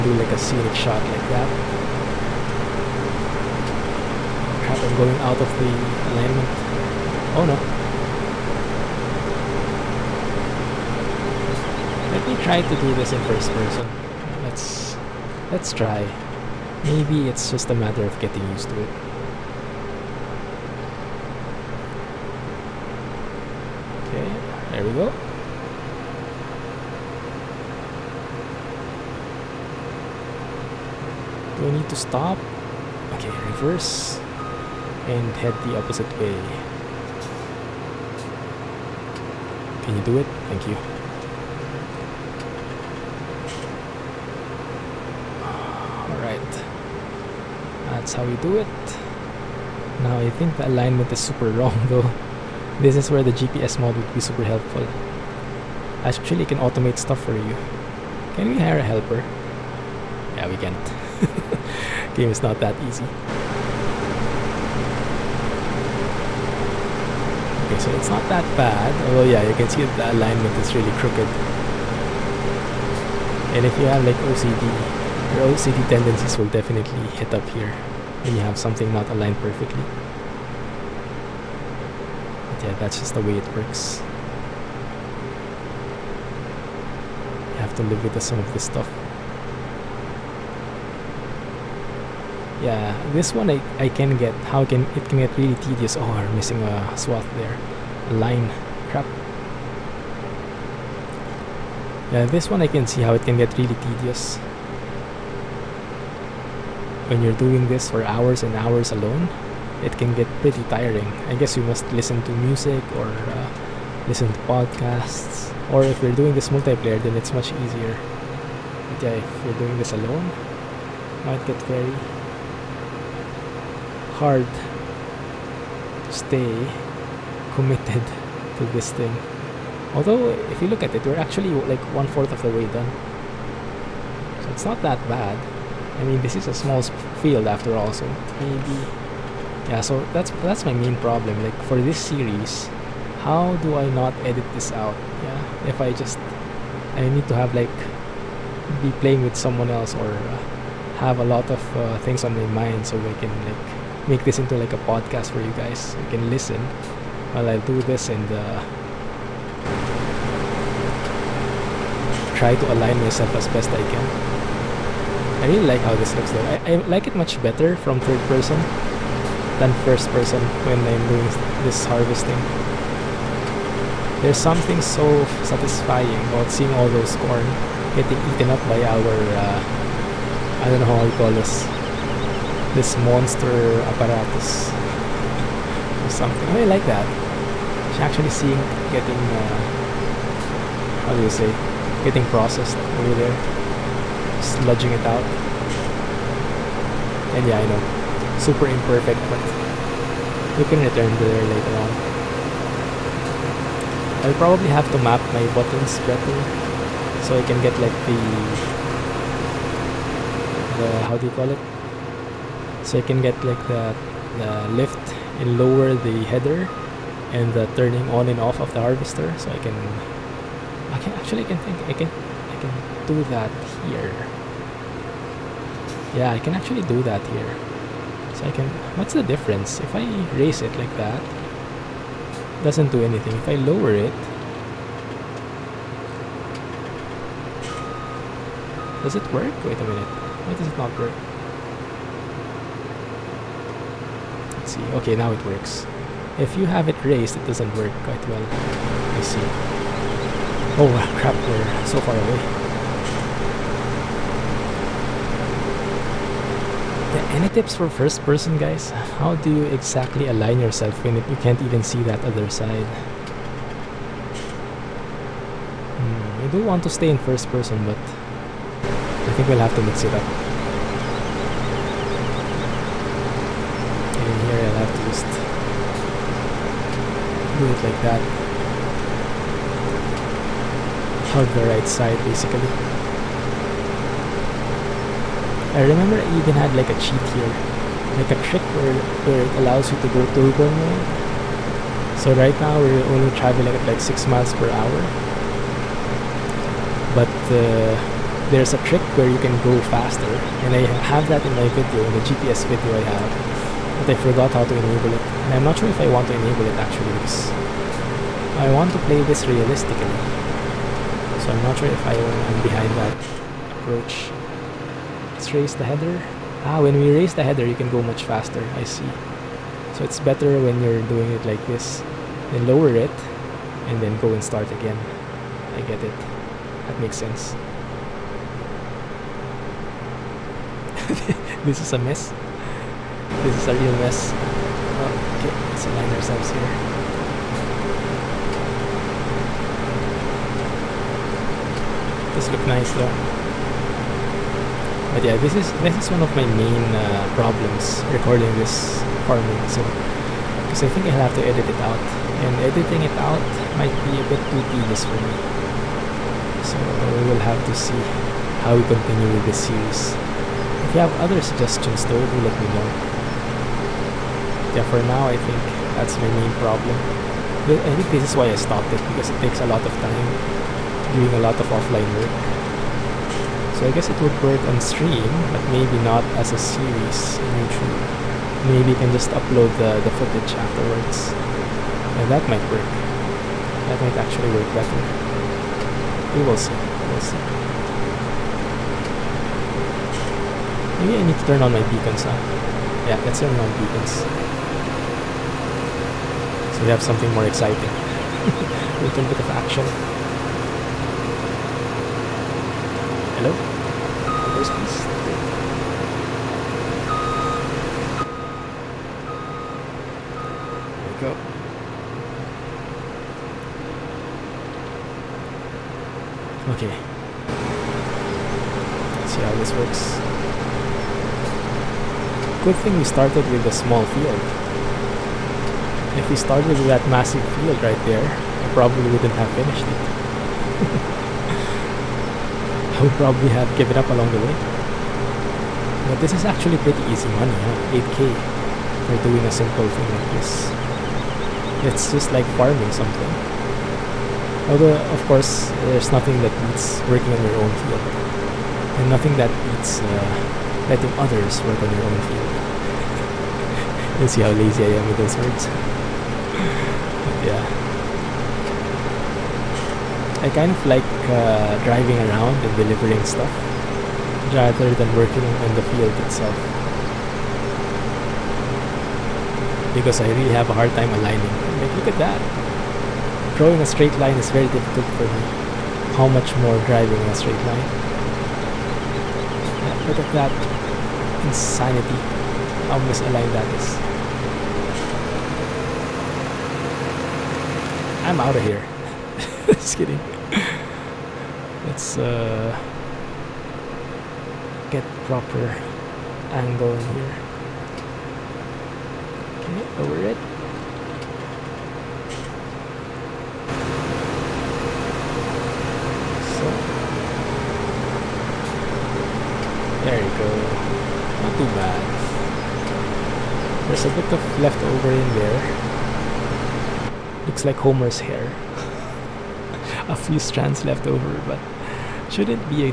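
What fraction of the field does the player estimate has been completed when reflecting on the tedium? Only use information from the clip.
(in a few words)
one fourth.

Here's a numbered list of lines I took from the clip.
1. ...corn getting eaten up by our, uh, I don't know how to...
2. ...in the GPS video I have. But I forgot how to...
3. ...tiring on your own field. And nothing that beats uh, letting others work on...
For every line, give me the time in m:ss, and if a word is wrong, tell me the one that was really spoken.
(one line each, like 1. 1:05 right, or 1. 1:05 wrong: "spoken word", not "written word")
1. 2:57 right
2. 5:02 right
3. 7:27 wrong: "working", not "tiring".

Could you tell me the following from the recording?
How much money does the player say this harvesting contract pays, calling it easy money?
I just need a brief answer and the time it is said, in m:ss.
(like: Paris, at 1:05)
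8k, at 7:17.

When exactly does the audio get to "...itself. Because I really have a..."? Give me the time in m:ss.
7:46.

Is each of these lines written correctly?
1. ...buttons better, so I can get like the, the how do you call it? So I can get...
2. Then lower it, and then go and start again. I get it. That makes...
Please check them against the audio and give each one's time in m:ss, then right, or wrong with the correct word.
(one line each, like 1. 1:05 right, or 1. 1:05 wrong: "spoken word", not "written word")
1. 3:25 right
2. 5:22 right.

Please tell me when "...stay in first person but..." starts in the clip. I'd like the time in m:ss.
4:26.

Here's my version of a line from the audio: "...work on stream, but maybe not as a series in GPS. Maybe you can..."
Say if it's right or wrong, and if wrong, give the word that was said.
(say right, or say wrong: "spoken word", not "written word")
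wrong: "YouTube", not "GPS".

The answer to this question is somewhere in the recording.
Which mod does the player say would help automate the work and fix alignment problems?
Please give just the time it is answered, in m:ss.
0:53.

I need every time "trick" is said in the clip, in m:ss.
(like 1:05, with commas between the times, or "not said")
4:48, 4:58.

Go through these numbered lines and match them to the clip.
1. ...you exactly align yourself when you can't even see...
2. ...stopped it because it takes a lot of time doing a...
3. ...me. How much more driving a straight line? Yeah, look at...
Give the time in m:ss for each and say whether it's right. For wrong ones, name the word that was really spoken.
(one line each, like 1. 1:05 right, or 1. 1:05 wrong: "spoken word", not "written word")
1. 4:19 right
2. 6:08 right
3. 7:55 right.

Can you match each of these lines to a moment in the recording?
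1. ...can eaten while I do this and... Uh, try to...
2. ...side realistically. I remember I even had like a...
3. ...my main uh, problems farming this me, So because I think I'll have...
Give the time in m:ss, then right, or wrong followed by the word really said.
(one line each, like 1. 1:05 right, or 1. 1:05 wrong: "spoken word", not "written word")
1. 2:36 wrong: "listen", not "eaten"
2. 4:41 wrong: "basically", not "realistically"
3. 5:46 wrong: "recording", not "farming".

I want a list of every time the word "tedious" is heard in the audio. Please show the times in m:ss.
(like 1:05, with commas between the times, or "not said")
1:35, 1:43, 5:54.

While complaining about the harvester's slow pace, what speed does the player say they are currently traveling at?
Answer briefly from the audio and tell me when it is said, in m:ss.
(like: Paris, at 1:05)
6 miles per hour, at 4:53.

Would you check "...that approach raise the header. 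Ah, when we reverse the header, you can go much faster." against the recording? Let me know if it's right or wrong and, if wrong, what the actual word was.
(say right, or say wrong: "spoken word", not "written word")
wrong: "raise", not "reverse".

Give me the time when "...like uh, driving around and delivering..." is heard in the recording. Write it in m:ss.
7:40.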